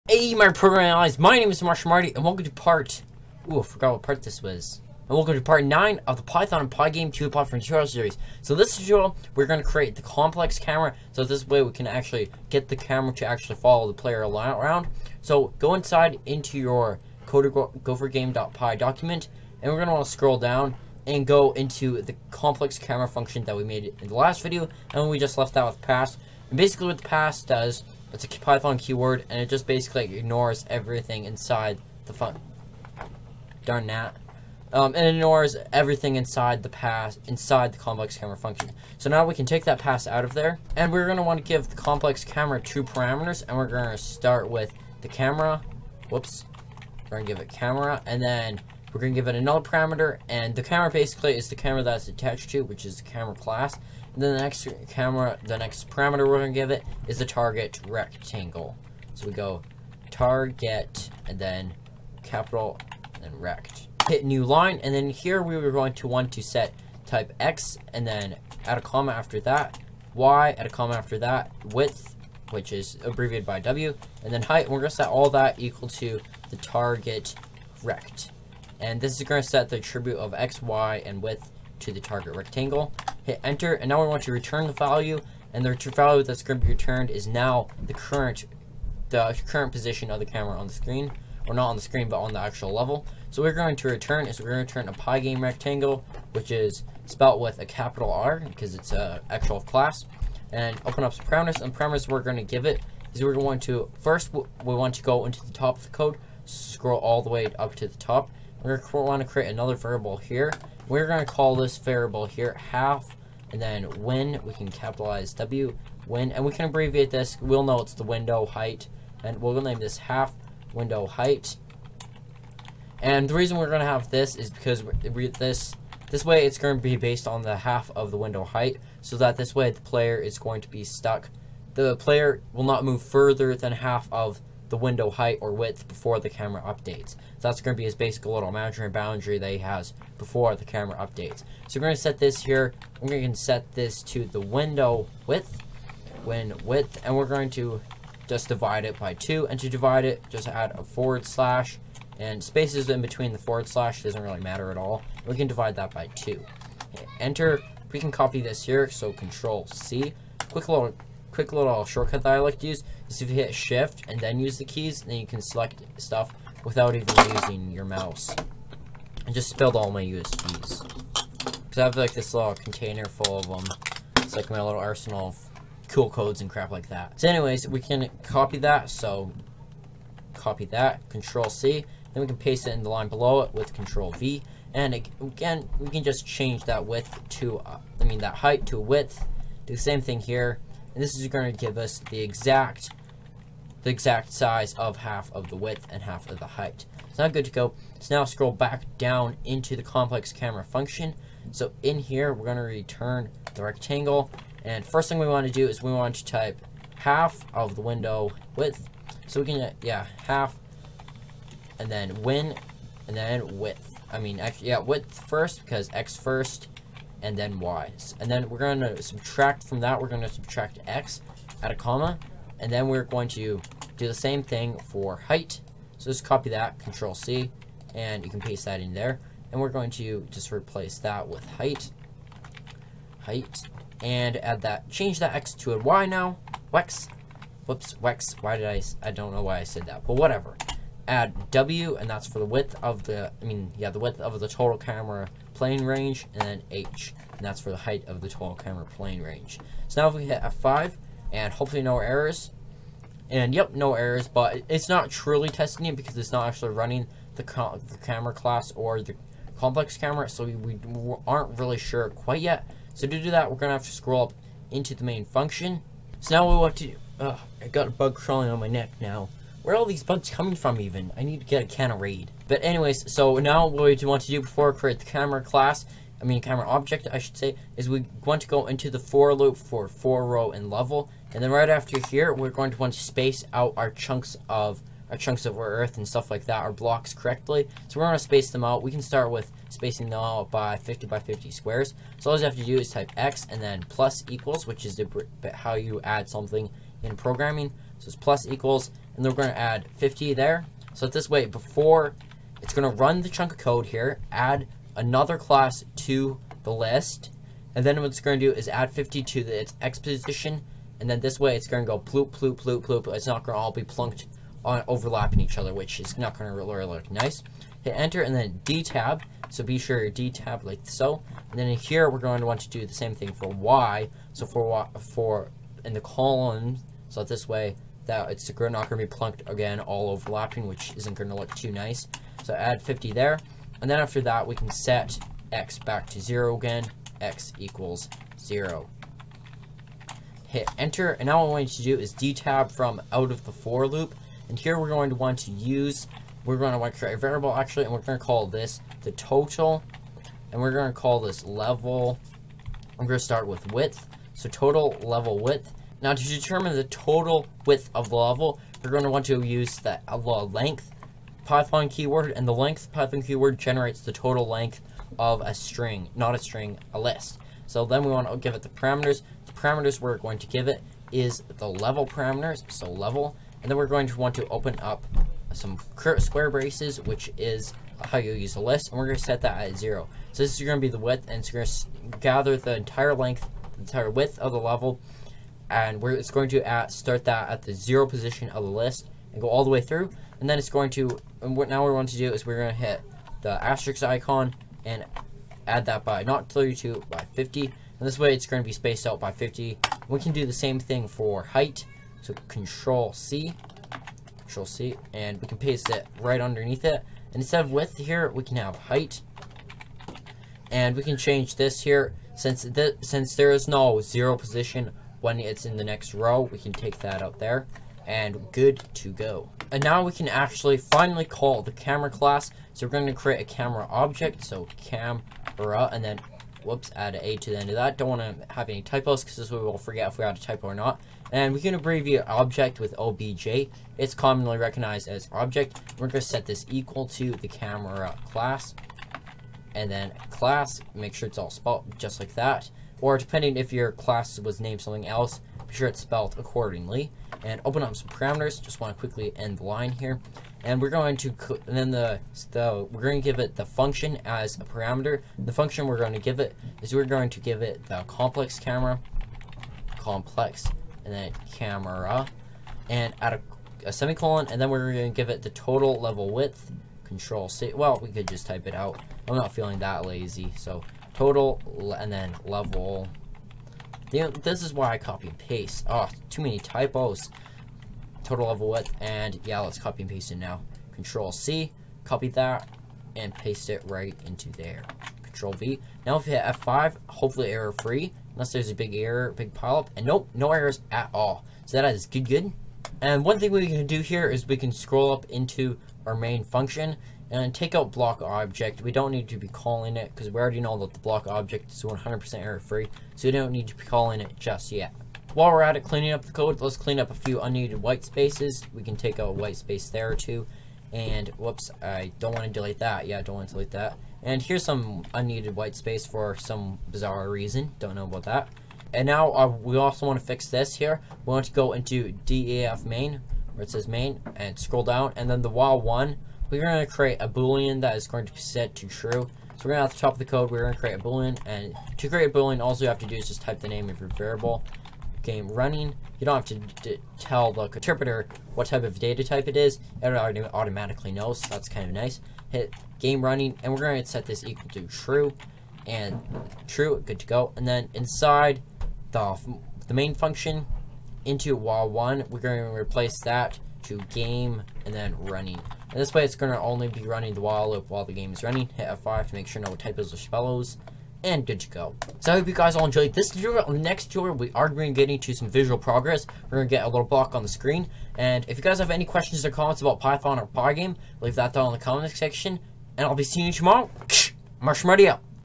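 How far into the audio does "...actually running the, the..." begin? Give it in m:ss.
4:16.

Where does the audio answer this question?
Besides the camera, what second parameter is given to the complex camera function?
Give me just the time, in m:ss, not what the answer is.
1:16.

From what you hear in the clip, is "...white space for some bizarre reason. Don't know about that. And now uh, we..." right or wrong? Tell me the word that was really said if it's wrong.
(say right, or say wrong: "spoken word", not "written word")
right.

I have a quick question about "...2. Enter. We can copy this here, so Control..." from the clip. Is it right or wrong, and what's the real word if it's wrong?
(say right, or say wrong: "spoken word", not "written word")
right.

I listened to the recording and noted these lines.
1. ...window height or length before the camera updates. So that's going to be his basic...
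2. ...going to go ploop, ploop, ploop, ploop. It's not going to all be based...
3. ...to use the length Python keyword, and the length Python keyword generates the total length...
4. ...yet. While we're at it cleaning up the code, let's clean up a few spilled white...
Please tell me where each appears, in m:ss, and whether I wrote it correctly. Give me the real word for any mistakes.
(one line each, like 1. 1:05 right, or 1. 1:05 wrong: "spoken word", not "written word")
1. 2:14 wrong: "width", not "length"
2. 5:11 wrong: "plunked", not "based"
3. 5:59 right
4. 8:24 wrong: "unneeded", not "spilled".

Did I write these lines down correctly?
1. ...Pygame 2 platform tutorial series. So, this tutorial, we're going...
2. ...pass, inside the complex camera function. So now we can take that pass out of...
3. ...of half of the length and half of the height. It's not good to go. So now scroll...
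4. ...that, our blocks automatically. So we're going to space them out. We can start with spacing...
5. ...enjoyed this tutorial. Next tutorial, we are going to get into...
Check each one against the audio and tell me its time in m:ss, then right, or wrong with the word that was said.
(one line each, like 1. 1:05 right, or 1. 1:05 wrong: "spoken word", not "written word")
1. 0:06 right
2. 0:36 right
3. 3:14 wrong: "width", not "length"
4. 4:46 wrong: "correctly", not "automatically"
5. 9:22 right.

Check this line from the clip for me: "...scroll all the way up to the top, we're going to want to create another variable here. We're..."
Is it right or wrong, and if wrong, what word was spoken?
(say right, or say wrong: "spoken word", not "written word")
right.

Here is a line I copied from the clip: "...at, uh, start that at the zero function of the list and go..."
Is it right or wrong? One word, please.
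wrong.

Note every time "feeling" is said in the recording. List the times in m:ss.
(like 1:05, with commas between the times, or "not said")
7:49.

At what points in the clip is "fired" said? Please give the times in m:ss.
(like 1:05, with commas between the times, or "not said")
not said.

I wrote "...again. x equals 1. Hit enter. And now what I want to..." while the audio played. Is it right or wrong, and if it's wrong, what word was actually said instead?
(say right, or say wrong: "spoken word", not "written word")
wrong: "0", not "1".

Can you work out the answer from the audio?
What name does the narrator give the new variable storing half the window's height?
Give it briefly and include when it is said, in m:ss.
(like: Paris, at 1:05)
half window height, at 1:59.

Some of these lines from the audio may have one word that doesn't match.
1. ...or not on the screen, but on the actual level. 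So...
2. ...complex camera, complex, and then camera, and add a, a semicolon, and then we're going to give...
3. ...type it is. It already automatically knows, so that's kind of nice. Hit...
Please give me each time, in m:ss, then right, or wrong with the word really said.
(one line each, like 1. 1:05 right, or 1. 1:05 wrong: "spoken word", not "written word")
1. 1:31 right
2. 7:38 right
3. 8:59 right.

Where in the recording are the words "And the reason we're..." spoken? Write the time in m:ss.
2:03.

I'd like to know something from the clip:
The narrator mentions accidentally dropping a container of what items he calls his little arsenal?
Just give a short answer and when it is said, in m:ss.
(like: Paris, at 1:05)
USBs, at 2:50.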